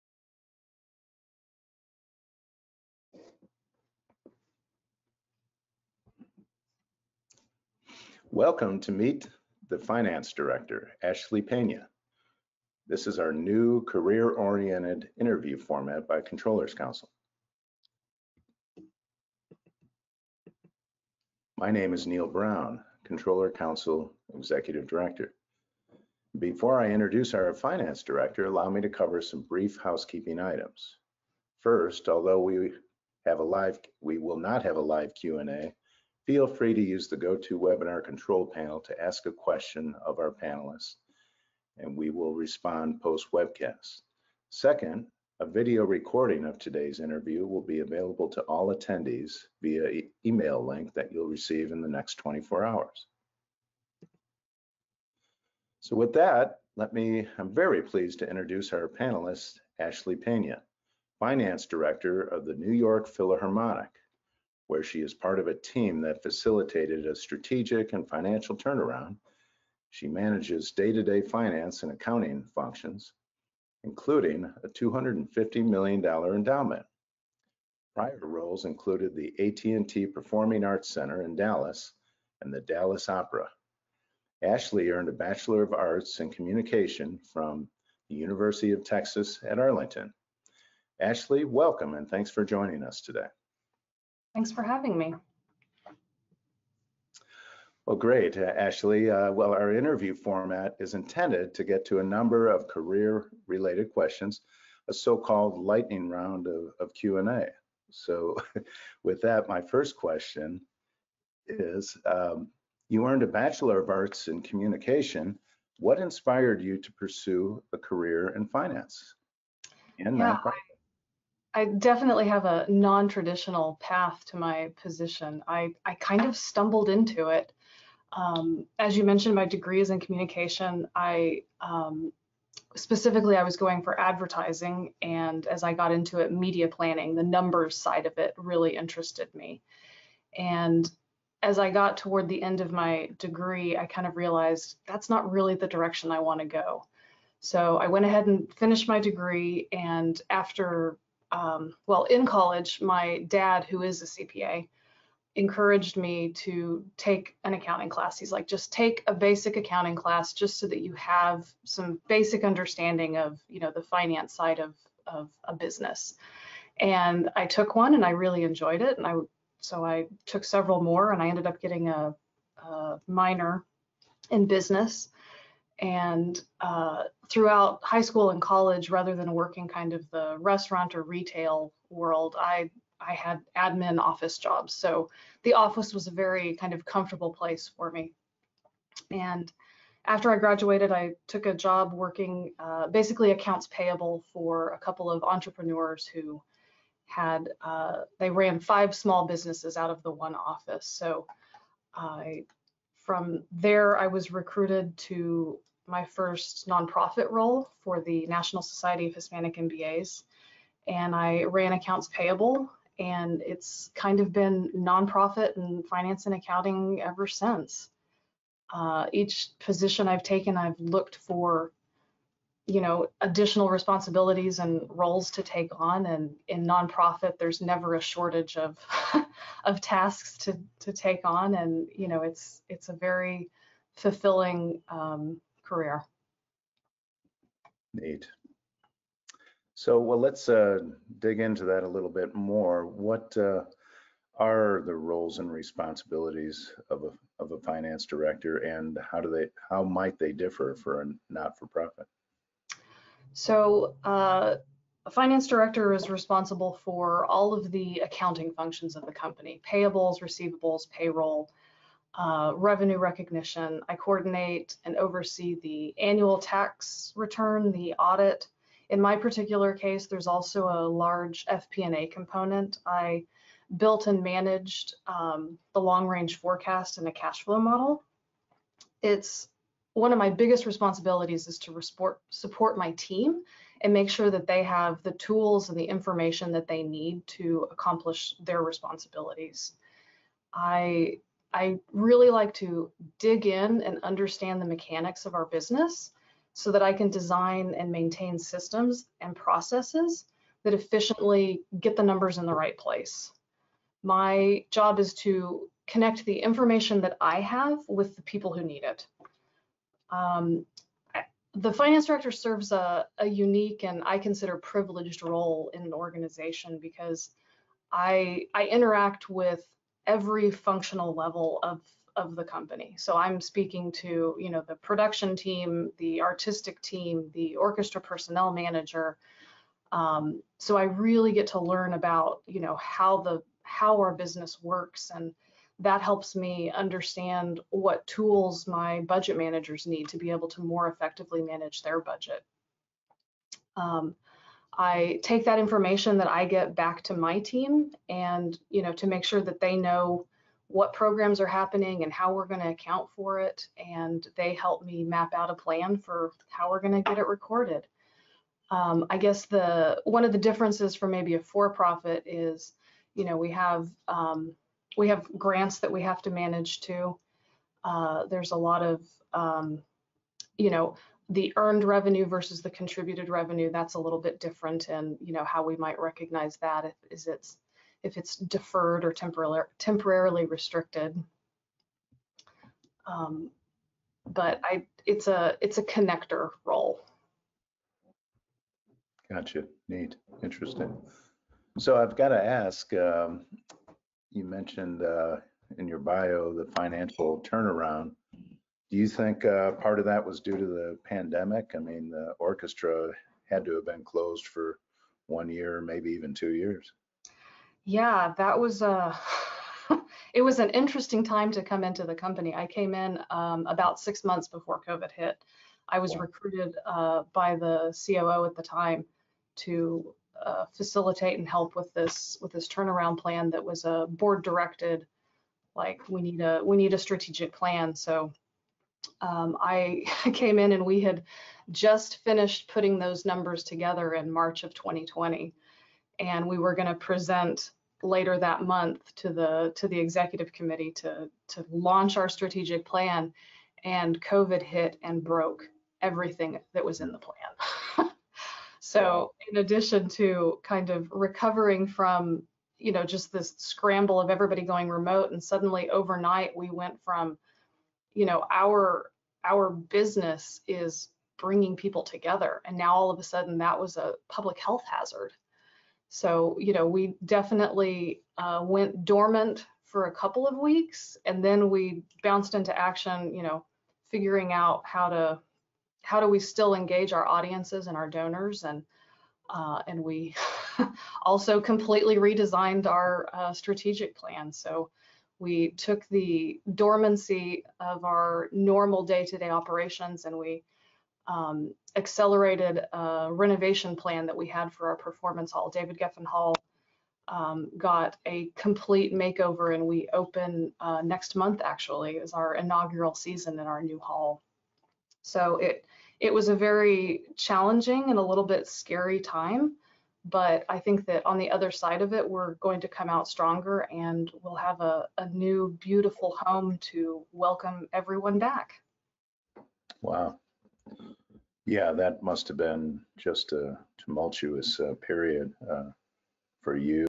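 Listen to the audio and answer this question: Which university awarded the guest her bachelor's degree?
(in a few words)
University of Texas at Arlington.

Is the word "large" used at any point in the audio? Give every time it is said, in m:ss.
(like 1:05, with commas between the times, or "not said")
4:30.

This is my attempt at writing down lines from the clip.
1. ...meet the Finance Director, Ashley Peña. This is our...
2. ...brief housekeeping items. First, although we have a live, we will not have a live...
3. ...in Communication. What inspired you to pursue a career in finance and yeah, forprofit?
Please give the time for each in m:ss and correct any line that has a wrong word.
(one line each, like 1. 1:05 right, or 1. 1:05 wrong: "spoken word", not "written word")
1. 0:08 right
2. 0:29 right
3. 1:54 wrong: "nonprofit", not "forprofit".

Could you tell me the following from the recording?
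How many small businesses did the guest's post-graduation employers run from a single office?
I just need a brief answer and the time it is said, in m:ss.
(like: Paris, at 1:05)
5, at 3:18.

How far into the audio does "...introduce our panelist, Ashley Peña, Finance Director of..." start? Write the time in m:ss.
0:58.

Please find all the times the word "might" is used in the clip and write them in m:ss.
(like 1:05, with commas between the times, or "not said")
4:09, 6:15.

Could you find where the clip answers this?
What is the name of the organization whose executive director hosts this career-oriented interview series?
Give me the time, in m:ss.
0:16.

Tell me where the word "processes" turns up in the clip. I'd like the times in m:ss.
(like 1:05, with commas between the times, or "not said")
4:59.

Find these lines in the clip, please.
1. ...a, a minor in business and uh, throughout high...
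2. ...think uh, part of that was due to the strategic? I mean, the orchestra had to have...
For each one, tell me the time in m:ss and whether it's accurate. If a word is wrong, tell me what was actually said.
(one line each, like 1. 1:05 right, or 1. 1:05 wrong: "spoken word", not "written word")
1. 2:51 right
2. 6:39 wrong: "pandemic", not "strategic".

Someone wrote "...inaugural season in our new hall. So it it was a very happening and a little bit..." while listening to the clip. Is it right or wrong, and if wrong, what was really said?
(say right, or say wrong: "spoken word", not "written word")
wrong: "challenging", not "happening".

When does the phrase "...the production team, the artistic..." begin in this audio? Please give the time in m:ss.
5:24.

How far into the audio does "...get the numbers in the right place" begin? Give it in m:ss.
5:01.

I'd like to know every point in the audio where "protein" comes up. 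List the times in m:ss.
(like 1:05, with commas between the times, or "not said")
not said.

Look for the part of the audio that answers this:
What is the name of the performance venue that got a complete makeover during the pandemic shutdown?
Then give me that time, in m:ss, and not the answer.
8:15.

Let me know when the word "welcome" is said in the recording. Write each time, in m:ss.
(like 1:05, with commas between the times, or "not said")
0:08, 1:31, 8:37.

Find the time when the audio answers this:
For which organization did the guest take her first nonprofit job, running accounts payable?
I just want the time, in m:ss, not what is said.
3:28.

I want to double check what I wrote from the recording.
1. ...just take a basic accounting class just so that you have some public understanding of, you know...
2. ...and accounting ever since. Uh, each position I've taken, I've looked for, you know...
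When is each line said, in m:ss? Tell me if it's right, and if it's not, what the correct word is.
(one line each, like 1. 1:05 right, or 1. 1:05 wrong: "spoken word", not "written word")
1. 2:38 wrong: "basic", not "public"
2. 3:36 right.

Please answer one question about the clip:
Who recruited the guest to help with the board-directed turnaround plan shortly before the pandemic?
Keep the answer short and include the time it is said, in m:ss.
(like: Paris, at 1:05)
the COO, at 6:58.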